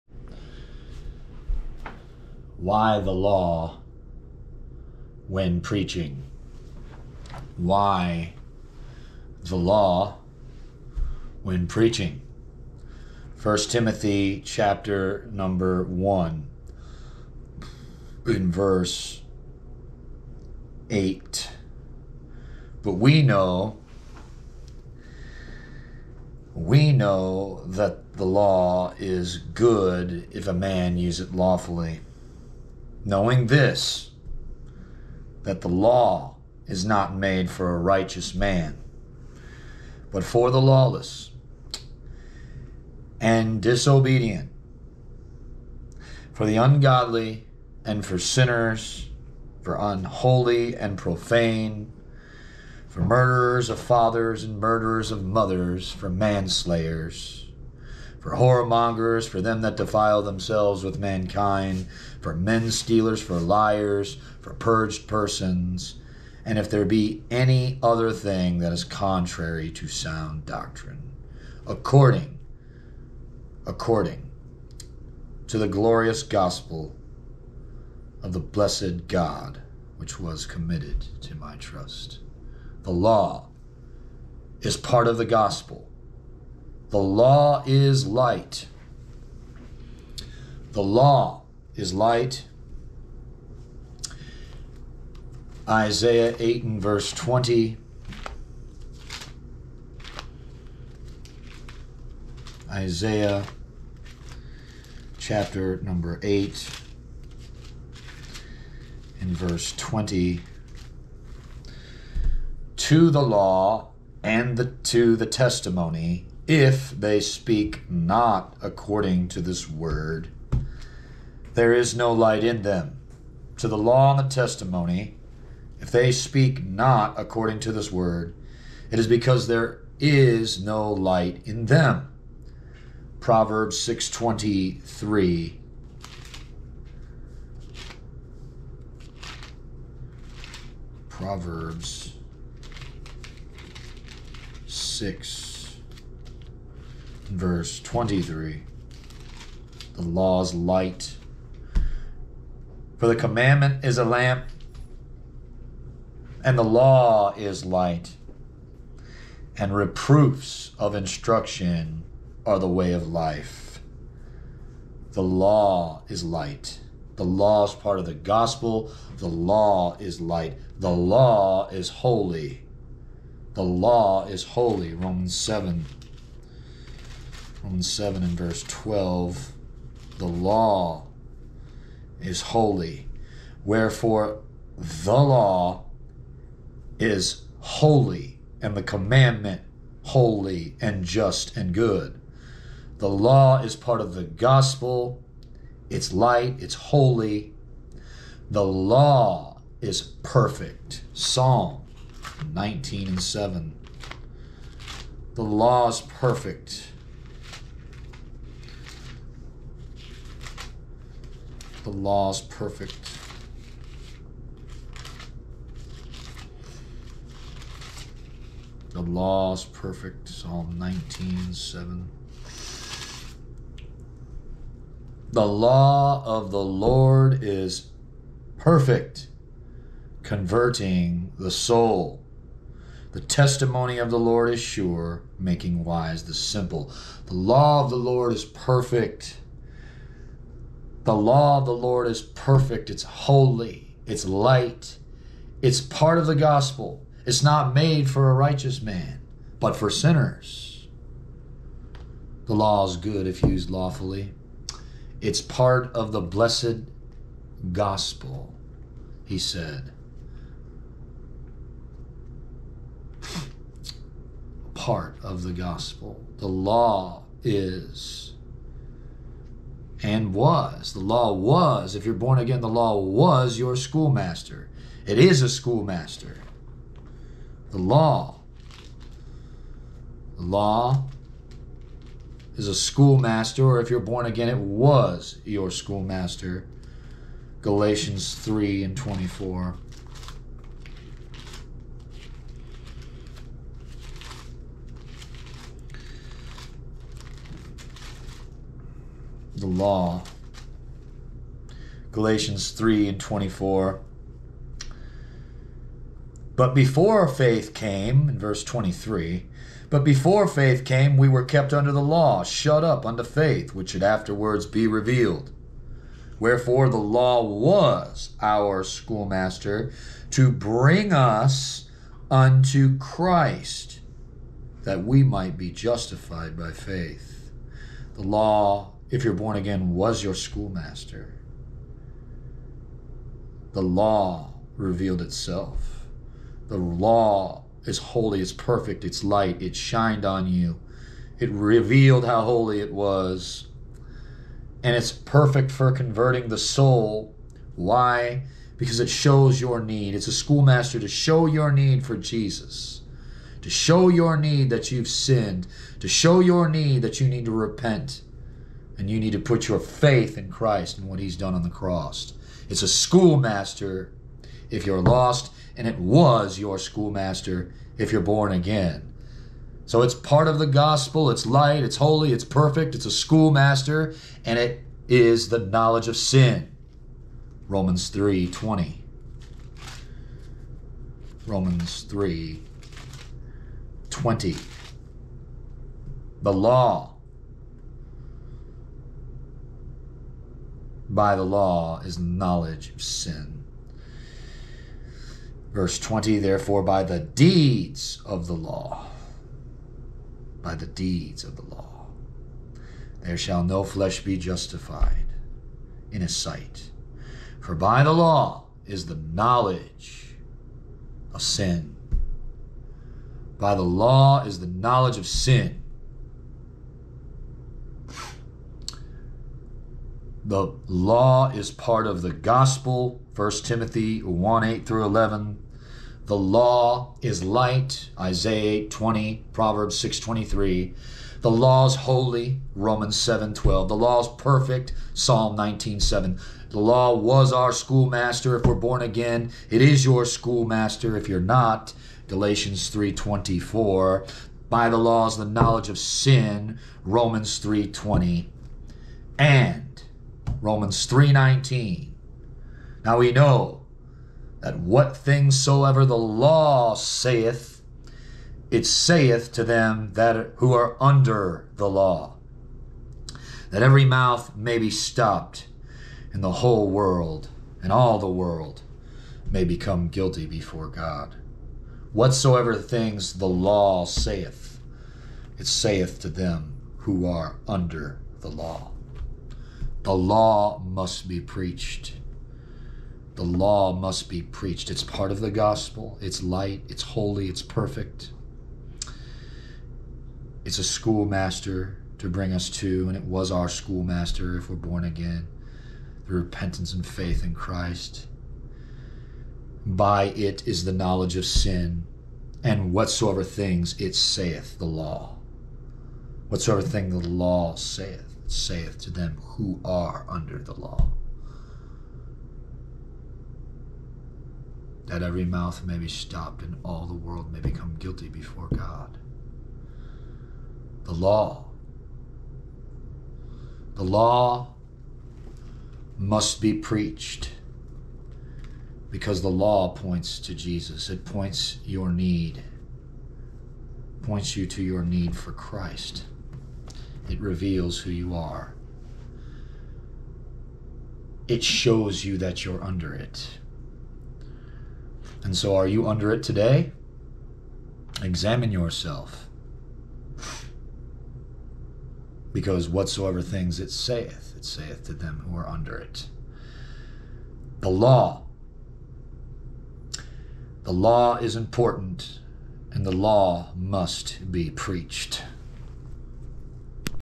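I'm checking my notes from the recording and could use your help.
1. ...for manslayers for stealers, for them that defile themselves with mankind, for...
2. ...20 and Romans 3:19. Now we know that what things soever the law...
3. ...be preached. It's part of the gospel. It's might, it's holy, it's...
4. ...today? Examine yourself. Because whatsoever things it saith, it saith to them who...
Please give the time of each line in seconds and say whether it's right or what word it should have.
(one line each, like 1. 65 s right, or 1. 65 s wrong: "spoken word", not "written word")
1. 55 s wrong: "whoremongers", not "stealers"
2. 447 s right
3. 484 s wrong: "light", not "might"
4. 546 s right.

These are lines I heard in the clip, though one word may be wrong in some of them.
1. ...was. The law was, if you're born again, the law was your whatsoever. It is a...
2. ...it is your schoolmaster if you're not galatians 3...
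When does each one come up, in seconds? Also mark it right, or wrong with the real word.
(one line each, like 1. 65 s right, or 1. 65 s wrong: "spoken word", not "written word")
1. 270 s wrong: "schoolmaster", not "whatsoever"
2. 439 s right.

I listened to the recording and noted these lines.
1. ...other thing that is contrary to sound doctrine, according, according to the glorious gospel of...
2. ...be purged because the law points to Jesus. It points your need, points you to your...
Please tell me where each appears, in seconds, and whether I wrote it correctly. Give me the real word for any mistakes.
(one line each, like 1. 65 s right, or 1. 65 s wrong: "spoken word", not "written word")
1. 67 s right
2. 526 s wrong: "preached", not "purged".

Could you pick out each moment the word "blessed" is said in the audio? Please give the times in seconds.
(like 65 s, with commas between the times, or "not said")
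78 s, 256 s.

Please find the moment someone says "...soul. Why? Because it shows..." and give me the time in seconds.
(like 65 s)
346 s.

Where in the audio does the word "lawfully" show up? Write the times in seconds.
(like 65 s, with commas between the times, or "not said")
31 s, 253 s.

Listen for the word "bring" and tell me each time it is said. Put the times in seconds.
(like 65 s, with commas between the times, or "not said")
320 s, 492 s.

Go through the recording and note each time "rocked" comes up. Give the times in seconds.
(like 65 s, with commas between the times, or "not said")
not said.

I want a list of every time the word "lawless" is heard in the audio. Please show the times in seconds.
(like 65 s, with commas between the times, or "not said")
40 s.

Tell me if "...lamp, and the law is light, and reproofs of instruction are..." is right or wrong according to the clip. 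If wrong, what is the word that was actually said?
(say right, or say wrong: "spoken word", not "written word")
right.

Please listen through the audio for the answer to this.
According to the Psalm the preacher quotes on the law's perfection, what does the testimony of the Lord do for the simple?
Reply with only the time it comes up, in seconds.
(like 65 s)
235 s.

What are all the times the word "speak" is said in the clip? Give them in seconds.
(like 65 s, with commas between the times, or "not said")
117 s, 126 s.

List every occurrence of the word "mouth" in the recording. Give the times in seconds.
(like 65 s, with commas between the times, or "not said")
464 s, 515 s.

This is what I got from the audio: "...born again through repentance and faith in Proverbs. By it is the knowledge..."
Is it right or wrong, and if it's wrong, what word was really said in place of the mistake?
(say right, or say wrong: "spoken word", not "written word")
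wrong: "Christ", not "Proverbs".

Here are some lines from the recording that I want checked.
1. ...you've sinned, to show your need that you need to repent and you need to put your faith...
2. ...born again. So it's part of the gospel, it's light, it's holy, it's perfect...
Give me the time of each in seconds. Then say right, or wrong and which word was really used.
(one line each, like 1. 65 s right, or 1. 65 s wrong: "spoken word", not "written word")
1. 354 s right
2. 368 s right.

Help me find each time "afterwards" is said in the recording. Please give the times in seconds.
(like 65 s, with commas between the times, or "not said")
314 s.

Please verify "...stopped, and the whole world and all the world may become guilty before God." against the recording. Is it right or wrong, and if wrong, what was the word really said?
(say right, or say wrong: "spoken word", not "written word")
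right.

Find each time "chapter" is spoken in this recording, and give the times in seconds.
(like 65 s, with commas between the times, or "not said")
14 s, 105 s.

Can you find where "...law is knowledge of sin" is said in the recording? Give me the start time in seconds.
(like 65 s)
391 s.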